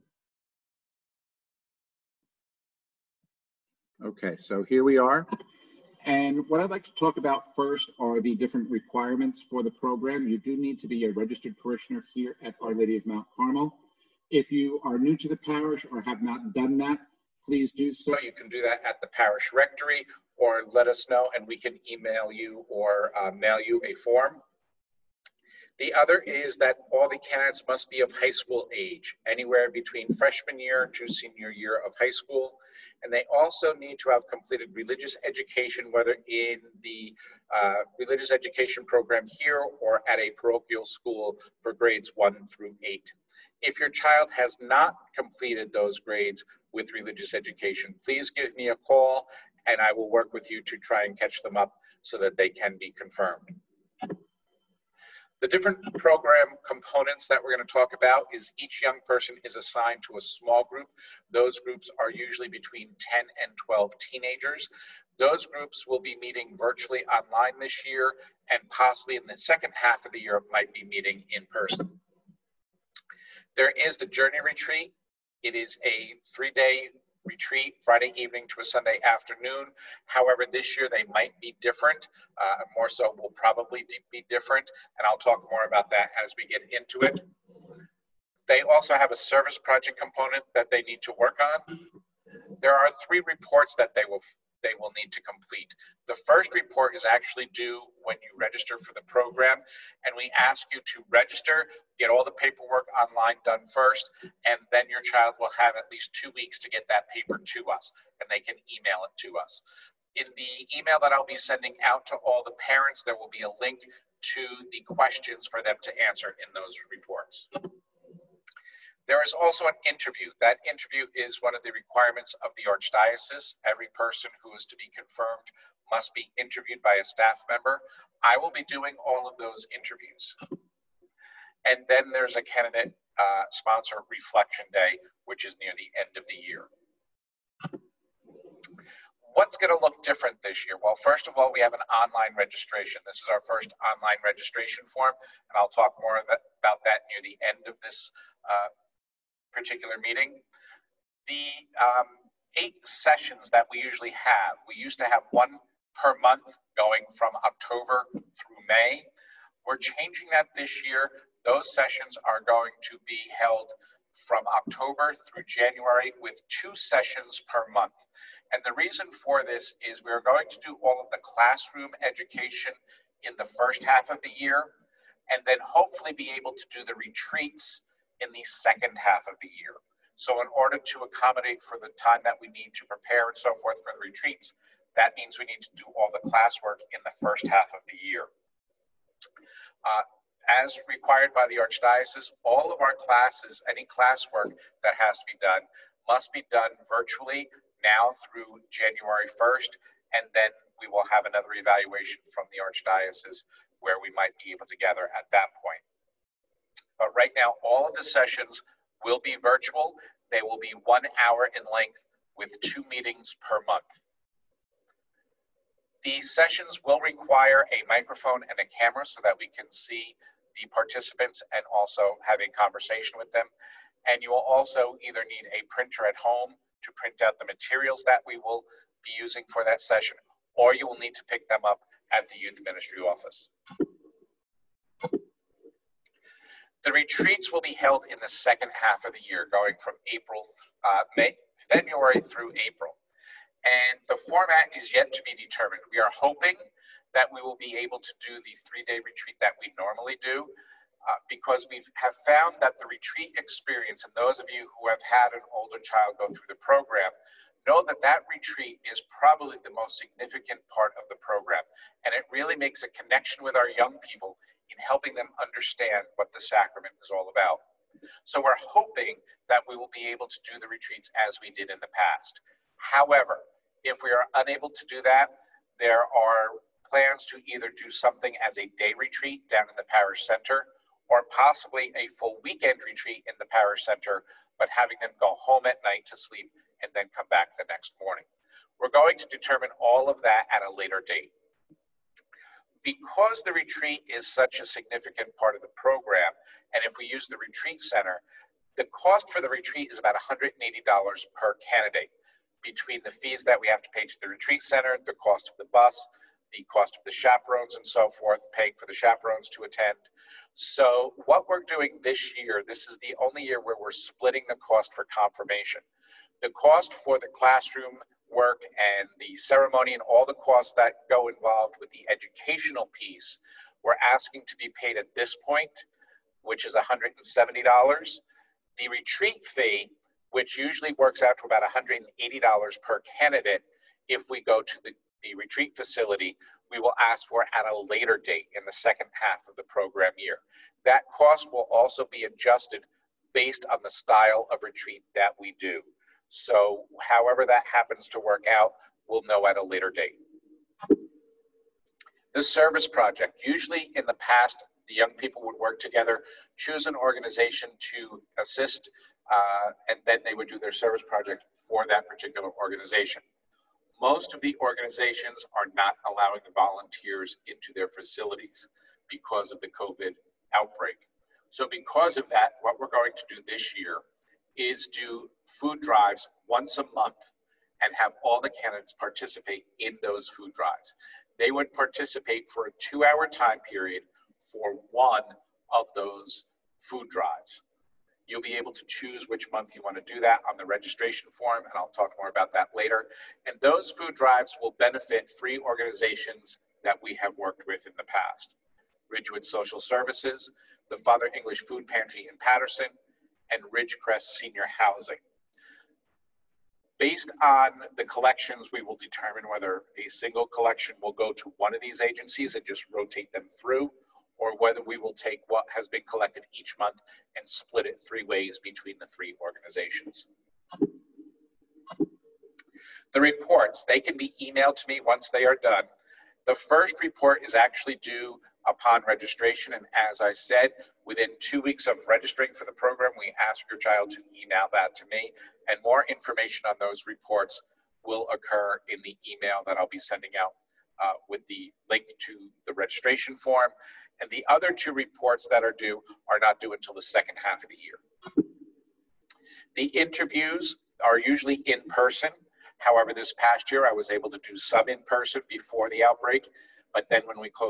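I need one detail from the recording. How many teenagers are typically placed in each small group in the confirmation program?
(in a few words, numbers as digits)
10 and 12.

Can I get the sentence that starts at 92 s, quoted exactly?
There are three reports that they will they will need to complete.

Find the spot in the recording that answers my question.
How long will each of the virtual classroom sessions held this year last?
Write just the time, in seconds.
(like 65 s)
210 s.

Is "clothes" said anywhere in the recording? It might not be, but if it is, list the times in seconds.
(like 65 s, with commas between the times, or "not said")
not said.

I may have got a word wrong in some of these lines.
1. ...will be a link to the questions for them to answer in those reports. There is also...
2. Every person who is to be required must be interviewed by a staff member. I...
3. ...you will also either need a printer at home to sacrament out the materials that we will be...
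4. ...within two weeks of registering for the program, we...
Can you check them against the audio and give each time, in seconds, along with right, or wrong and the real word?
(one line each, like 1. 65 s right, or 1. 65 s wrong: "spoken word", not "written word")
1. 113 s right
2. 123 s wrong: "confirmed", not "required"
3. 224 s wrong: "print", not "sacrament"
4. 431 s right.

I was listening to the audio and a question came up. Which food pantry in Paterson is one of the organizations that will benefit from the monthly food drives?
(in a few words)
Father English Food Pantry.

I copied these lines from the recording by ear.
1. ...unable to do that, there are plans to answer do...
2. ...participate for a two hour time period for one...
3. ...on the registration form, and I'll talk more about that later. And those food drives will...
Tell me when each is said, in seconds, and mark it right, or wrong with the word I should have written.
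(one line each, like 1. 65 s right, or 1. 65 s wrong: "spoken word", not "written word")
1. 274 s wrong: "either", not "answer"
2. 381 s right
3. 390 s right.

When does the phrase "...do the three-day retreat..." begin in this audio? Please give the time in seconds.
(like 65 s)
248 s.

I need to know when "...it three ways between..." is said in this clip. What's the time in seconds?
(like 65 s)
417 s.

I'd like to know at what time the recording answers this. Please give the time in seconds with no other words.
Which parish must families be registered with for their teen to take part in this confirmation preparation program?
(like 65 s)
12 s.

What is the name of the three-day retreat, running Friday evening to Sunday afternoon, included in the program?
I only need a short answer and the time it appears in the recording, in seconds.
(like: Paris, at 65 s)
Journey Retreat, at 74 s.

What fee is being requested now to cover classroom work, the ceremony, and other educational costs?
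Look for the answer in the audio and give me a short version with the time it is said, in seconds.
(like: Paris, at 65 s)
$170, at 326 s.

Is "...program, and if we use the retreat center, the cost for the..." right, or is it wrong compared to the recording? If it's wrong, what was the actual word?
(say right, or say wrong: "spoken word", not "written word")
right.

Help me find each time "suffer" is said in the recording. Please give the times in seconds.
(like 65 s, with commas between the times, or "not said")
not said.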